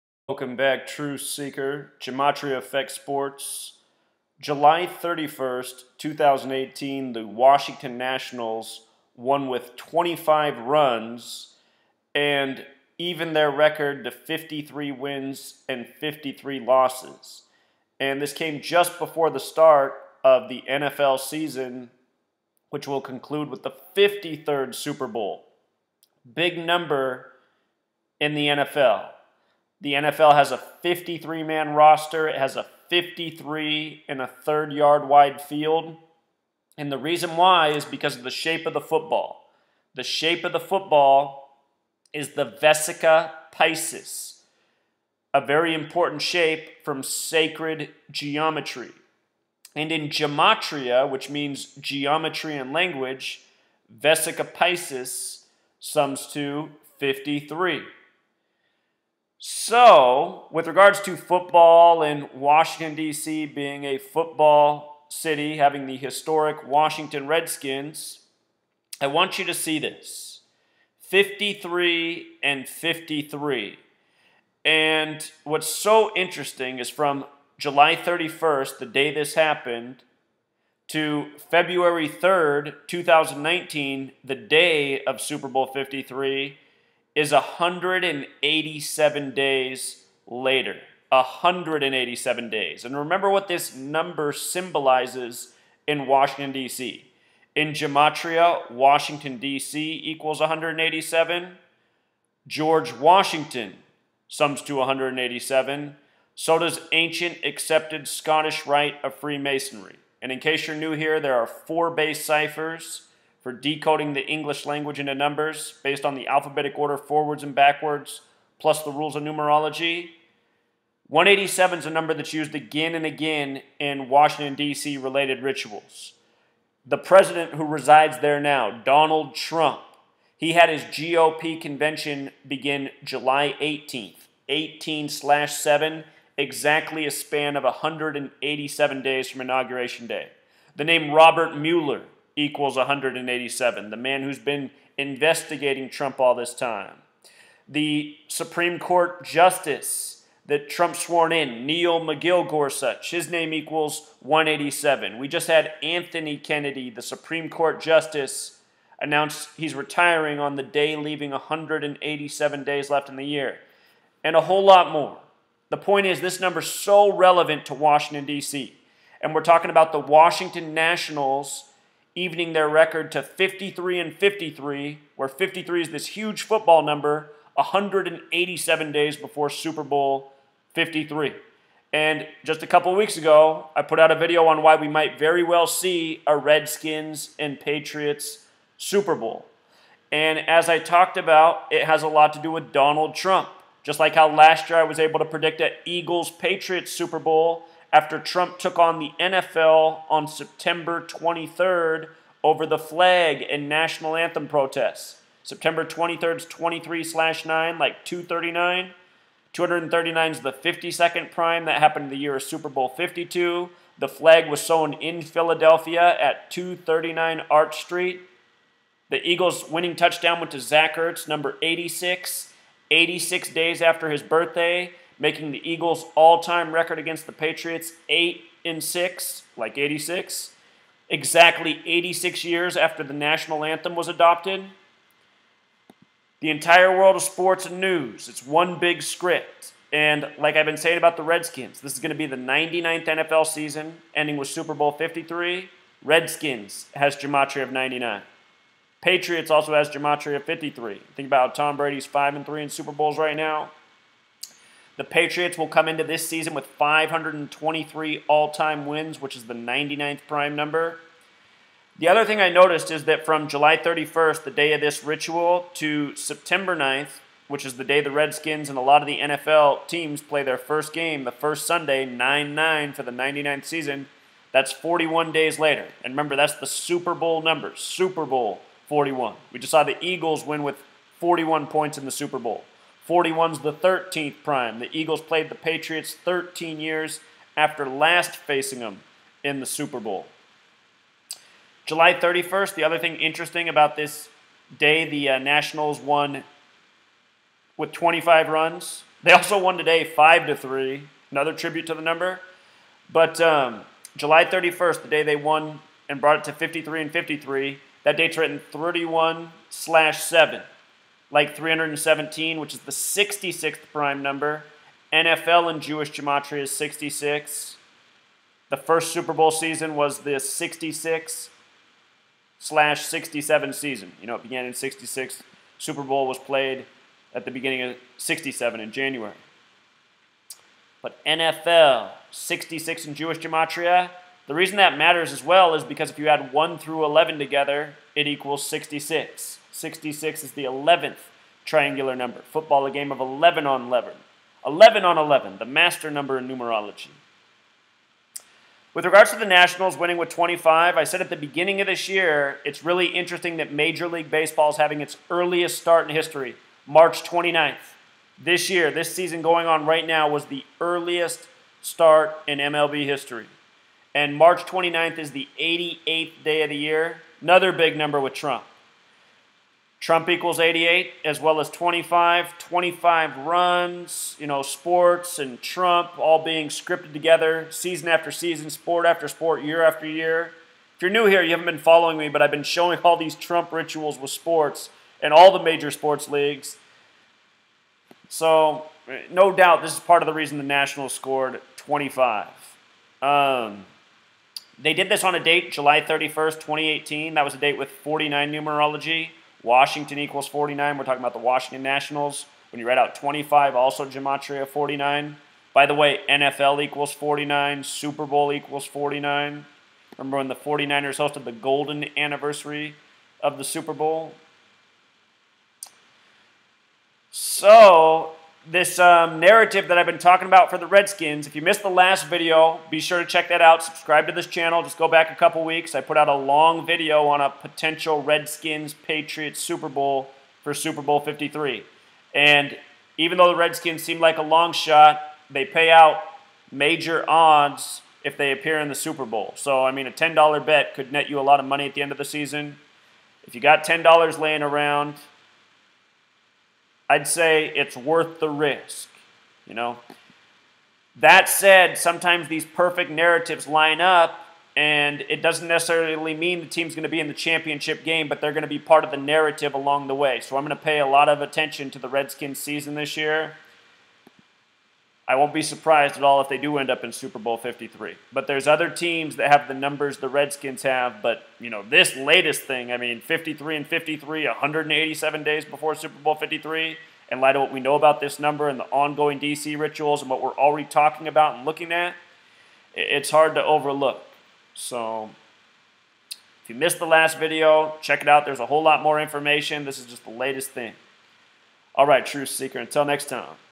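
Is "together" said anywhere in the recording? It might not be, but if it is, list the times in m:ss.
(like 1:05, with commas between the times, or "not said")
5:37, 6:17.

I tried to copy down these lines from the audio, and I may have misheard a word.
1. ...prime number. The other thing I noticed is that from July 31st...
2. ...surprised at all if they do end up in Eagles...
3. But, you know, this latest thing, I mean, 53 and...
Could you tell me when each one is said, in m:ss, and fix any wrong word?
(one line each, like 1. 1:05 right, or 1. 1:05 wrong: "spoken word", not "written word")
1. 4:20 right
2. 7:45 wrong: "Super", not "Eagles"
3. 7:51 right.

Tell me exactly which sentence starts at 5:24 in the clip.
You know, it began in 66.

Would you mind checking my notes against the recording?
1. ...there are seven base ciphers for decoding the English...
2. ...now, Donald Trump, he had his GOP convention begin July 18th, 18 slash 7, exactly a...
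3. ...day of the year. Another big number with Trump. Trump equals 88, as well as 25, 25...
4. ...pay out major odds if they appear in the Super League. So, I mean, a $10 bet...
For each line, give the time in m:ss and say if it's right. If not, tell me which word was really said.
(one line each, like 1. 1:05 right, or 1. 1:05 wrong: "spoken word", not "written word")
1. 1:51 wrong: "four", not "seven"
2. 2:08 right
3. 6:06 right
4. 7:15 wrong: "Bowl", not "League".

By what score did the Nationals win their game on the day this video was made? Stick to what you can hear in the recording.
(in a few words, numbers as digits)
5 to 3.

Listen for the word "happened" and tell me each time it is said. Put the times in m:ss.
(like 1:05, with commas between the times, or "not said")
1:19, 3:31.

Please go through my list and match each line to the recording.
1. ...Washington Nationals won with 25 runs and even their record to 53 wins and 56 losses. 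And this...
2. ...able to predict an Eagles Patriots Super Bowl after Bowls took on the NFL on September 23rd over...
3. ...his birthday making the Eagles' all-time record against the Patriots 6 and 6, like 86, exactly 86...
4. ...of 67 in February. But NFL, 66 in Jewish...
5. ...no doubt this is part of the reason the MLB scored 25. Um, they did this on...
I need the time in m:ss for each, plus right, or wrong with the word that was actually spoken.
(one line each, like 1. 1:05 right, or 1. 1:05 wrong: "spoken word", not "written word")
1. 0:07 wrong: "53", not "56"
2. 3:14 wrong: "Trump", not "Bowls"
3. 3:44 wrong: "8", not "6"
4. 5:27 wrong: "January", not "February"
5. 6:29 wrong: "Nationals", not "MLB".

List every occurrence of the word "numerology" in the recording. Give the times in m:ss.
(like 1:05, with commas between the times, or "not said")
1:59, 5:46, 6:38.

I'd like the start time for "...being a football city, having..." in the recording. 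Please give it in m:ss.
1:03.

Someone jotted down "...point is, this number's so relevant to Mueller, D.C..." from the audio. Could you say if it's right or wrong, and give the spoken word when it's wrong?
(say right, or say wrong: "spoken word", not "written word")
wrong: "Washington", not "Mueller".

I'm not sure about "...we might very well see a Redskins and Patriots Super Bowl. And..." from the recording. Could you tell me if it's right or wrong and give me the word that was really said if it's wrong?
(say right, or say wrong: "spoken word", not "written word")
right.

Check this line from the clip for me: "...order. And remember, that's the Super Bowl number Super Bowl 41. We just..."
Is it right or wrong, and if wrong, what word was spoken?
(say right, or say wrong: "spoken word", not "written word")
wrong: "later", not "order".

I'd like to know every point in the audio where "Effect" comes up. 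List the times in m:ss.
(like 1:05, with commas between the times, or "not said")
0:02.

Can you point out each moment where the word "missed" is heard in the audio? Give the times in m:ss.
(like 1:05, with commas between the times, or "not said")
7:01, 8:06.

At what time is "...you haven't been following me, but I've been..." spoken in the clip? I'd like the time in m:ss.
6:21.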